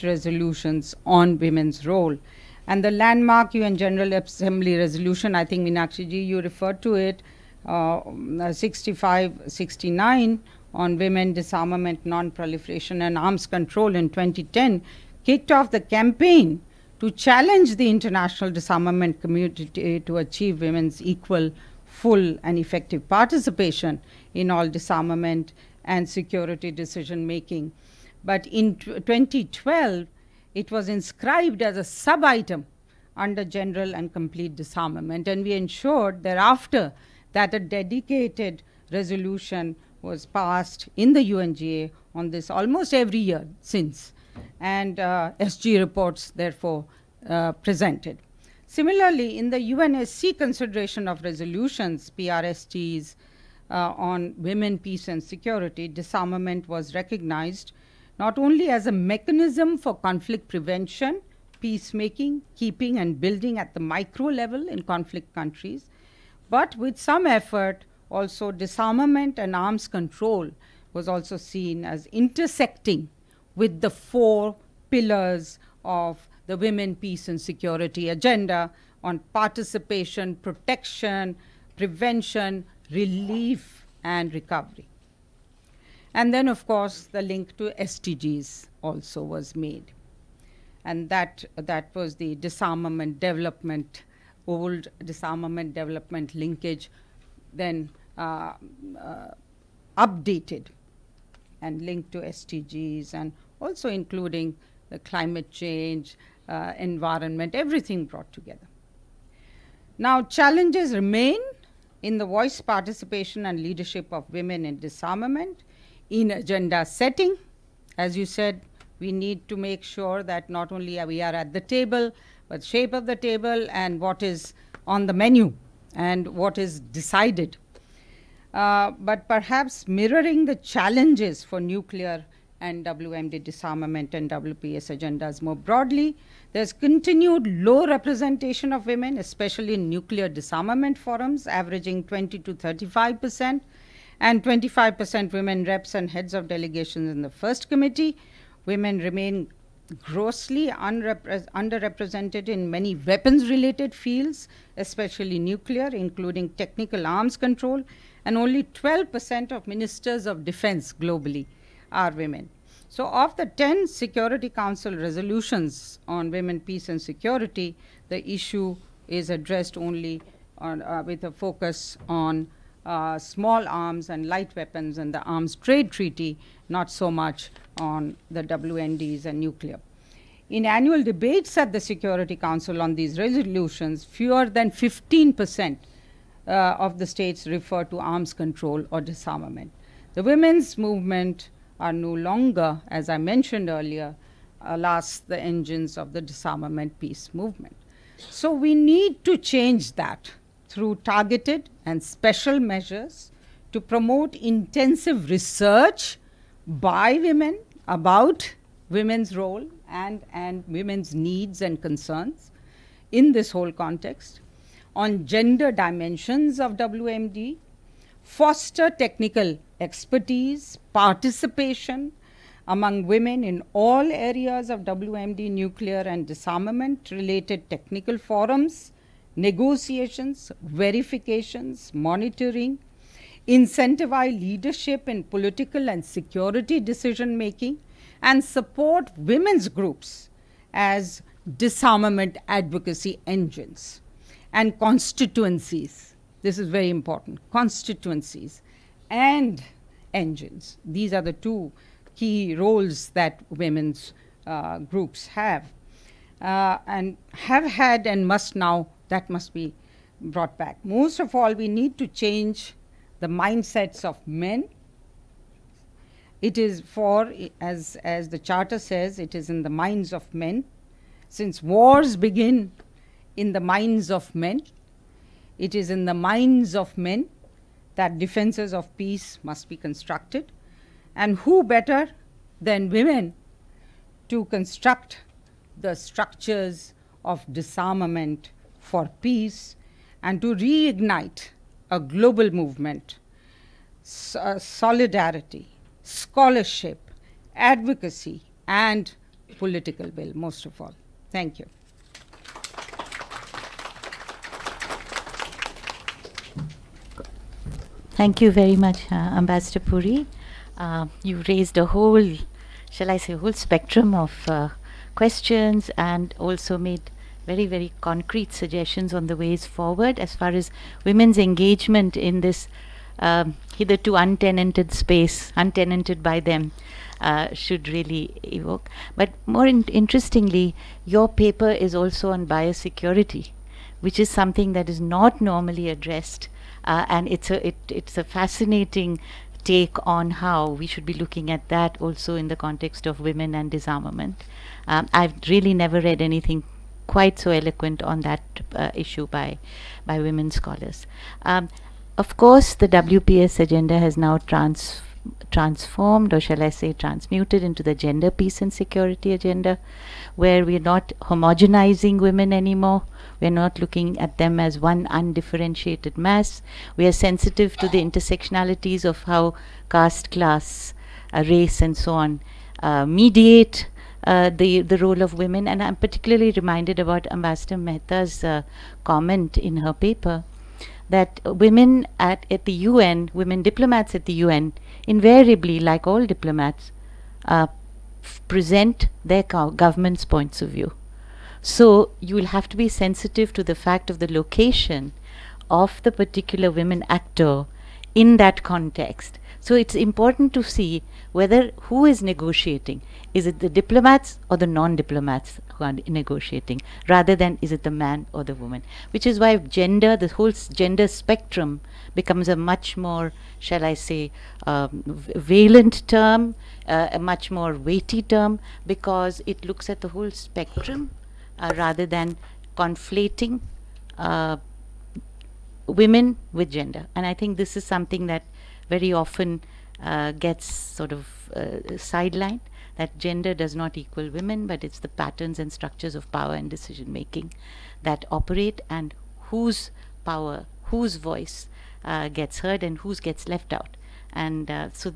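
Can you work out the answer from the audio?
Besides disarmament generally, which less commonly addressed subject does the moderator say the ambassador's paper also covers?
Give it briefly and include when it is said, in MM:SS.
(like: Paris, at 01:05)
biosecurity, at 05:32.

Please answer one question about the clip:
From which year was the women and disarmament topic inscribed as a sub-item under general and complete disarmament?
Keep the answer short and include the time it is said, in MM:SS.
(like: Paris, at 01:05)
2012, at 00:28.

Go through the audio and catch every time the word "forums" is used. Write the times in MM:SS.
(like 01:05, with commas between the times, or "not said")
02:20, 03:48.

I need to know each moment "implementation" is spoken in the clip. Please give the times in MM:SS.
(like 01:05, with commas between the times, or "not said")
not said.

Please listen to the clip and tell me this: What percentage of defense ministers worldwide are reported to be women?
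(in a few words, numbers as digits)
12%.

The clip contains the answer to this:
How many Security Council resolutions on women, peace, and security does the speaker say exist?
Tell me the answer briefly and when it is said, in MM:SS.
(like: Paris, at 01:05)
10, at 02:43.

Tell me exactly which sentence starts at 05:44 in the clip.
Um, I've really never read anything quite so eloquent on that uh, issue by by women scholars.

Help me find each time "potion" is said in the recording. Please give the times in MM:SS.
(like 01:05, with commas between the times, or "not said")
not said.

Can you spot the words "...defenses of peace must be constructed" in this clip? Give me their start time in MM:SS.
04:38.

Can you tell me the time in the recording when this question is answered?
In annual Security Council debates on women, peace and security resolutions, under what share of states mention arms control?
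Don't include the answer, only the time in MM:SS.
03:04.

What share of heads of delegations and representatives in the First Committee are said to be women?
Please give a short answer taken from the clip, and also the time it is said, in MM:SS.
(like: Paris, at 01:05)
25%, at 02:24.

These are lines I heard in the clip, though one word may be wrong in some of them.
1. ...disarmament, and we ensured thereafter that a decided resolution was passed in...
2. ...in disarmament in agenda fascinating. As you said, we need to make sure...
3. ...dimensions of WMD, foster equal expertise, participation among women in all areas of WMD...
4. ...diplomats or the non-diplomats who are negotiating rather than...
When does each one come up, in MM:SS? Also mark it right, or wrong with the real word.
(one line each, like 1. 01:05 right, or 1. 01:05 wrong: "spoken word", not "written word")
1. 00:34 wrong: "dedicated", not "decided"
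2. 01:54 wrong: "setting", not "fascinating"
3. 03:35 wrong: "technical", not "equal"
4. 06:43 right.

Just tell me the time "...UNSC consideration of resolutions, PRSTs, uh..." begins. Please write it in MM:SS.
00:49.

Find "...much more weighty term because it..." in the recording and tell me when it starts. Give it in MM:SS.
06:57.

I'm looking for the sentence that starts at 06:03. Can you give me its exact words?
We're not looking at them as one undifferentiated mass.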